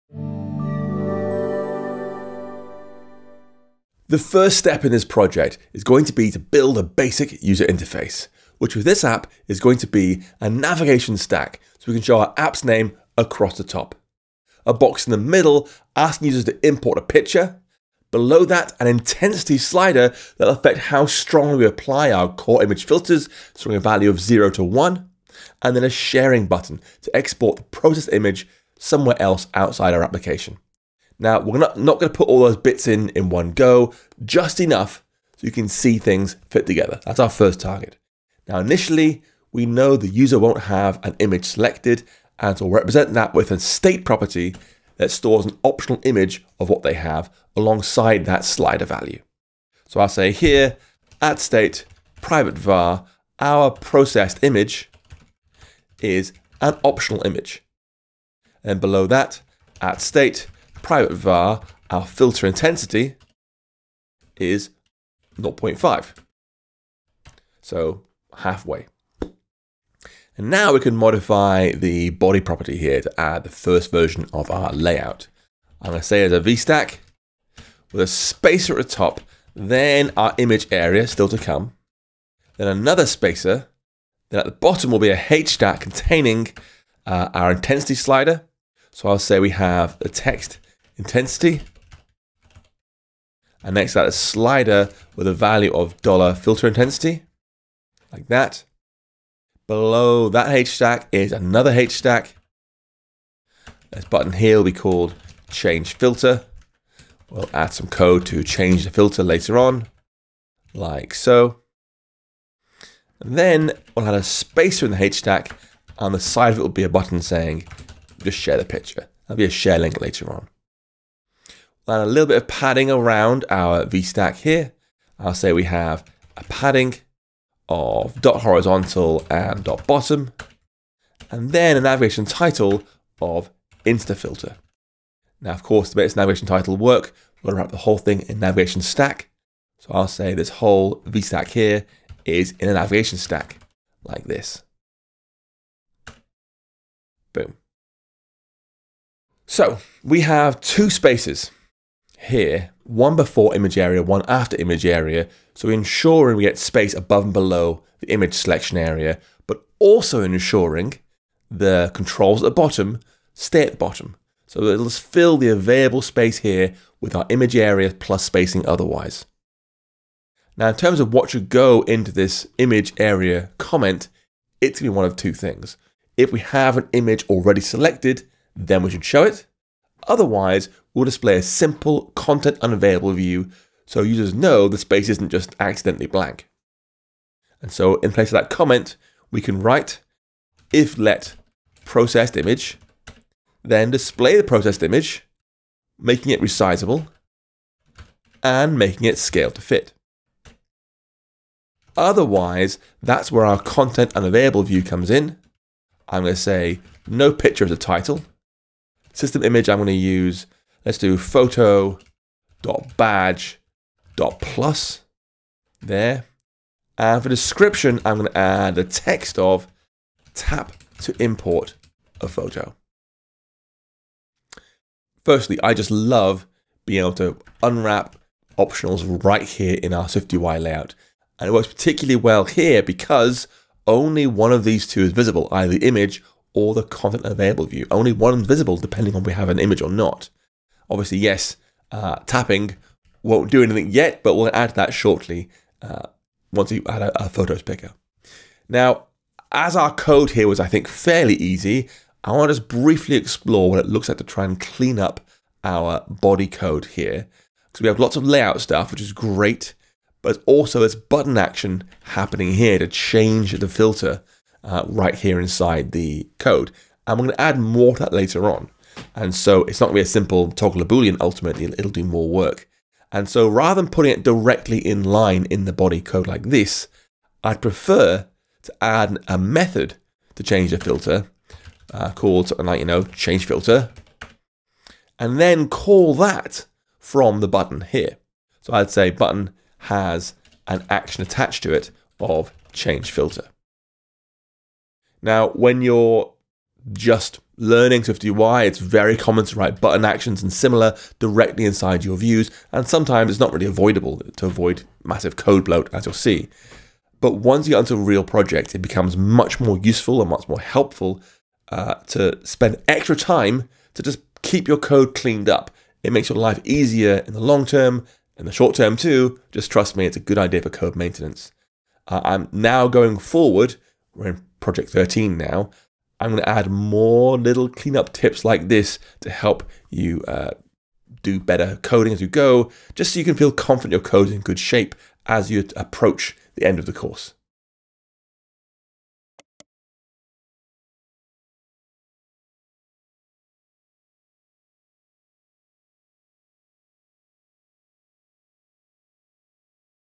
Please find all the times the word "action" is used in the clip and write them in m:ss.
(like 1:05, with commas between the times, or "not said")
4:21, 4:50, 5:00.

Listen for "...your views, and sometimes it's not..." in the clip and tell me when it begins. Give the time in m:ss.
5:02.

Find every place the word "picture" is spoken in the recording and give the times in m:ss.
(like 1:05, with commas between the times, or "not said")
0:17, 1:58, 3:27.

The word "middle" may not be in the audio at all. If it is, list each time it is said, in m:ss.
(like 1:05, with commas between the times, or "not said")
0:15.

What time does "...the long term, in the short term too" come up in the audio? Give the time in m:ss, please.
5:17.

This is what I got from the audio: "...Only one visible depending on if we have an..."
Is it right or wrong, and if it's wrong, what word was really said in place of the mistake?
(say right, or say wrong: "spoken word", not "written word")
right.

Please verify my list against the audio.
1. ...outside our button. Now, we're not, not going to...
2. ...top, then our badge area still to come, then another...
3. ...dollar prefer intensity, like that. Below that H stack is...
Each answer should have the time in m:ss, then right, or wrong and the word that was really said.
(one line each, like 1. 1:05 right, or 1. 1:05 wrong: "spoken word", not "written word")
1. 0:29 wrong: "application", not "button"
2. 1:18 wrong: "image", not "badge"
3. 1:36 wrong: "filter", not "prefer".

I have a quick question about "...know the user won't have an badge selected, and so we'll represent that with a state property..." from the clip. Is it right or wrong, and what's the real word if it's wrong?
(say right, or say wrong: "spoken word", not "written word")
wrong: "image", not "badge".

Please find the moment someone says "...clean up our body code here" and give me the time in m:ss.
4:14.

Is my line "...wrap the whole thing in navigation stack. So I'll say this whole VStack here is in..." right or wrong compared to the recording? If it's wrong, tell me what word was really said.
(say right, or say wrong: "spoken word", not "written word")
right.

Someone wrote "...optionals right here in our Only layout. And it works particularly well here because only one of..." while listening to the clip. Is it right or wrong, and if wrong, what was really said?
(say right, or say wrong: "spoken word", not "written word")
wrong: "SwiftUI", not "Only".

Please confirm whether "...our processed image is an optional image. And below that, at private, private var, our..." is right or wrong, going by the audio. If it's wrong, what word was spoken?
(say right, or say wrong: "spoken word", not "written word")
wrong: "state", not "private".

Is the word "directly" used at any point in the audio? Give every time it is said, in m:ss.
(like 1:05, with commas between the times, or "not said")
4:34, 5:01.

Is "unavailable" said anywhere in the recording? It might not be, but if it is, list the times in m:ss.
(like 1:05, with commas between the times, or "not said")
3:02, 3:24.